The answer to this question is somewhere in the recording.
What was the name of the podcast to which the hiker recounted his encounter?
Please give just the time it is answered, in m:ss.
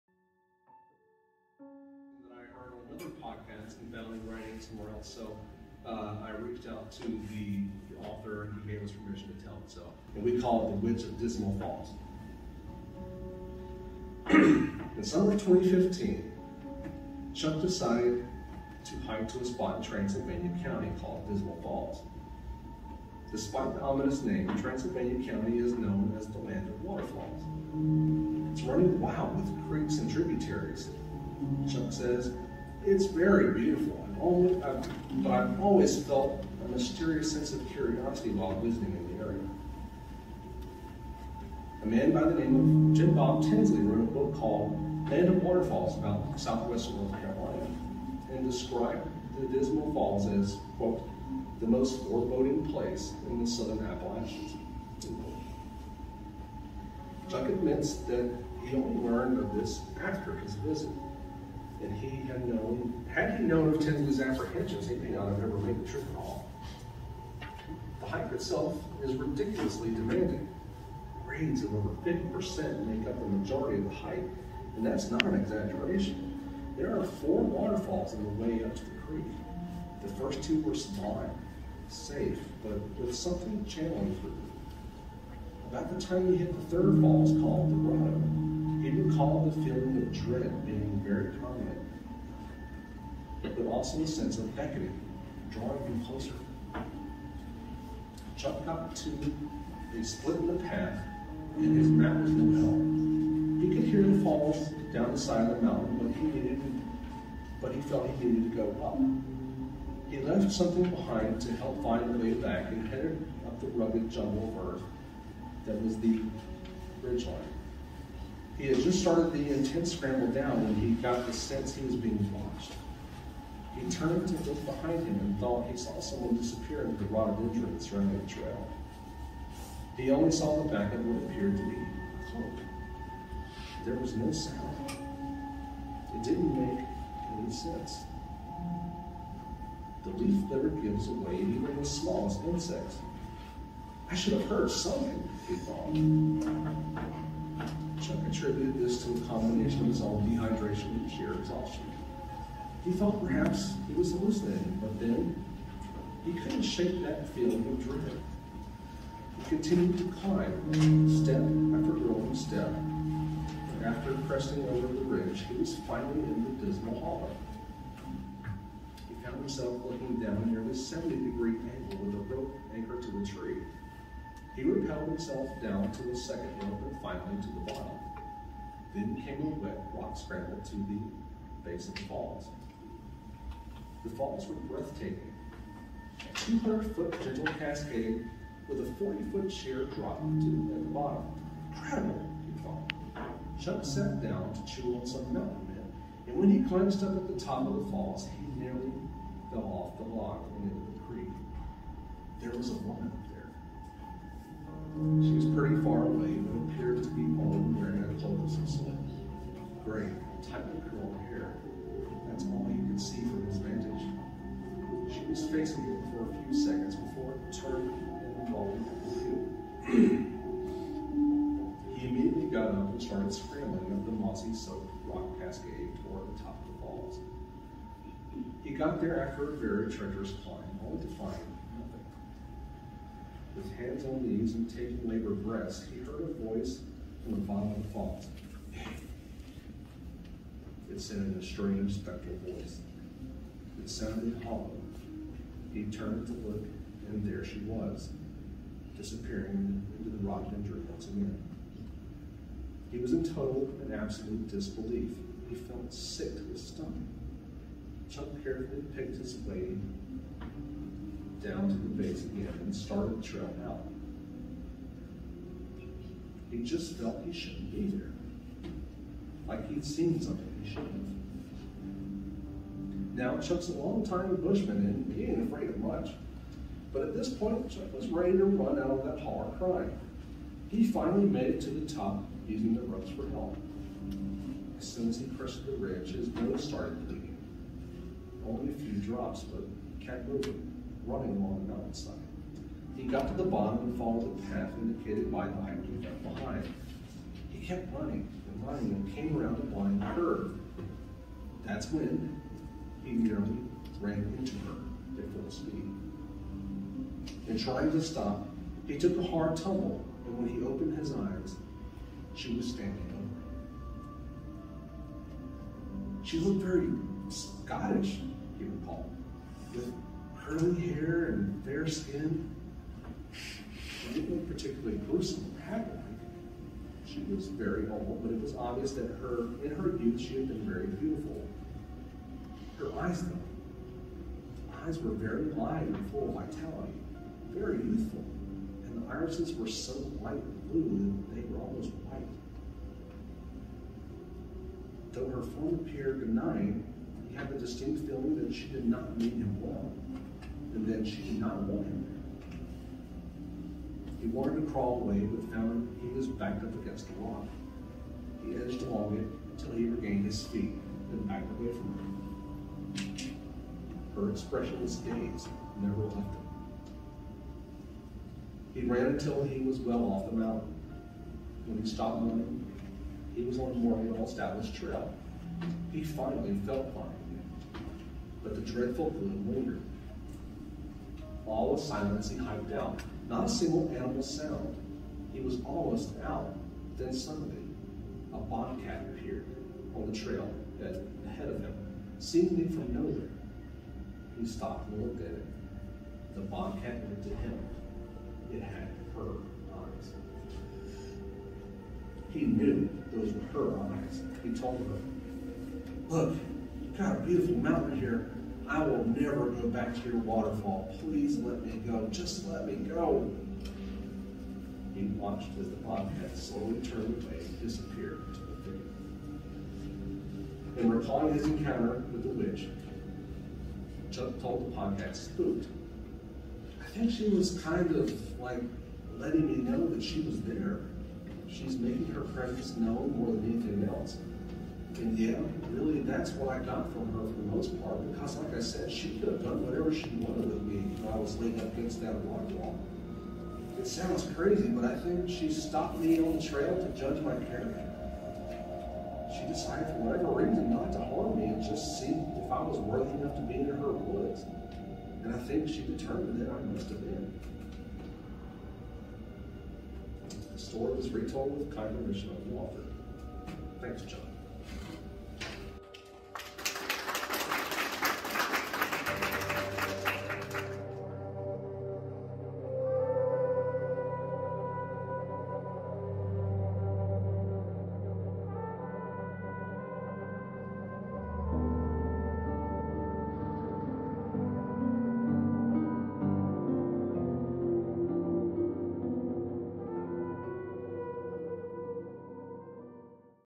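7:05.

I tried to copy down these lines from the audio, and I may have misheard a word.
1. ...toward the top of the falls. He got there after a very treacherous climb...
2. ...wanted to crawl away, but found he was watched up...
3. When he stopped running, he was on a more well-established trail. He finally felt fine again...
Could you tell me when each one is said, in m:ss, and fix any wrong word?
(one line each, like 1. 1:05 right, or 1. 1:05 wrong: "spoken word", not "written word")
1. 3:46 right
2. 5:54 wrong: "backed", not "watched"
3. 6:11 right.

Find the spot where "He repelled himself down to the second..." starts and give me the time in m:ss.
2:54.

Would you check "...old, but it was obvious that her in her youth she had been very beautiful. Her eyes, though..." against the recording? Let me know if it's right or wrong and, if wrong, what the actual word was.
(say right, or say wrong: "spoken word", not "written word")
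right.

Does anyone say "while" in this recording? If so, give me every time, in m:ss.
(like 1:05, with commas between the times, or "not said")
0:38, 7:21.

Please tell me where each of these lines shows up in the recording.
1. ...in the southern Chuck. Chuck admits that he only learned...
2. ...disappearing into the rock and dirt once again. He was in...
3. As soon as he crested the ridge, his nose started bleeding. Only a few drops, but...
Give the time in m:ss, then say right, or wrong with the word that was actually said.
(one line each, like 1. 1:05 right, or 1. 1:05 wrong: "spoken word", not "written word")
1. 0:53 wrong: "Appalachians", not "Chuck"
2. 4:08 right
3. 4:44 right.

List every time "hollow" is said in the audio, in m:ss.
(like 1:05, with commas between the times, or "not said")
2:46, 4:04.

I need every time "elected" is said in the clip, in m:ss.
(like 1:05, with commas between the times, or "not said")
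not said.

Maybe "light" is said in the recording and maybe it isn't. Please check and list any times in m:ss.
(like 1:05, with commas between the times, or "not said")
5:40.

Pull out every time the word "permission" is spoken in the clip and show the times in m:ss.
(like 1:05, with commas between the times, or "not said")
0:08, 7:41.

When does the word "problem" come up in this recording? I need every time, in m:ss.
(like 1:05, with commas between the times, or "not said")
not said.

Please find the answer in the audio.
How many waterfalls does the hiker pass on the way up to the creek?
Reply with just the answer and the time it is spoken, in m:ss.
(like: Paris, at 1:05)
4, at 1:17.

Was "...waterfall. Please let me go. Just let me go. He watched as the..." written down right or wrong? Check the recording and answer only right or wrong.
right.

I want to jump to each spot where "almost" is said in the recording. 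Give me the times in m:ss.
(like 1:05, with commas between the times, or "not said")
5:41, 6:25.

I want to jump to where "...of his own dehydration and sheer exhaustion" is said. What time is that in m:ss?
2:29.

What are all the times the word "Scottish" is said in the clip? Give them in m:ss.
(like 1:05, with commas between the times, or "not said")
5:17.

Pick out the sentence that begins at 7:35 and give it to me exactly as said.
And I think she determined that I must have been.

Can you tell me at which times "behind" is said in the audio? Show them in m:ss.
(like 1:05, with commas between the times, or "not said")
1:50, 2:04, 4:56.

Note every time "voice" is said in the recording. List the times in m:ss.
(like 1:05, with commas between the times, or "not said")
3:56, 4:02.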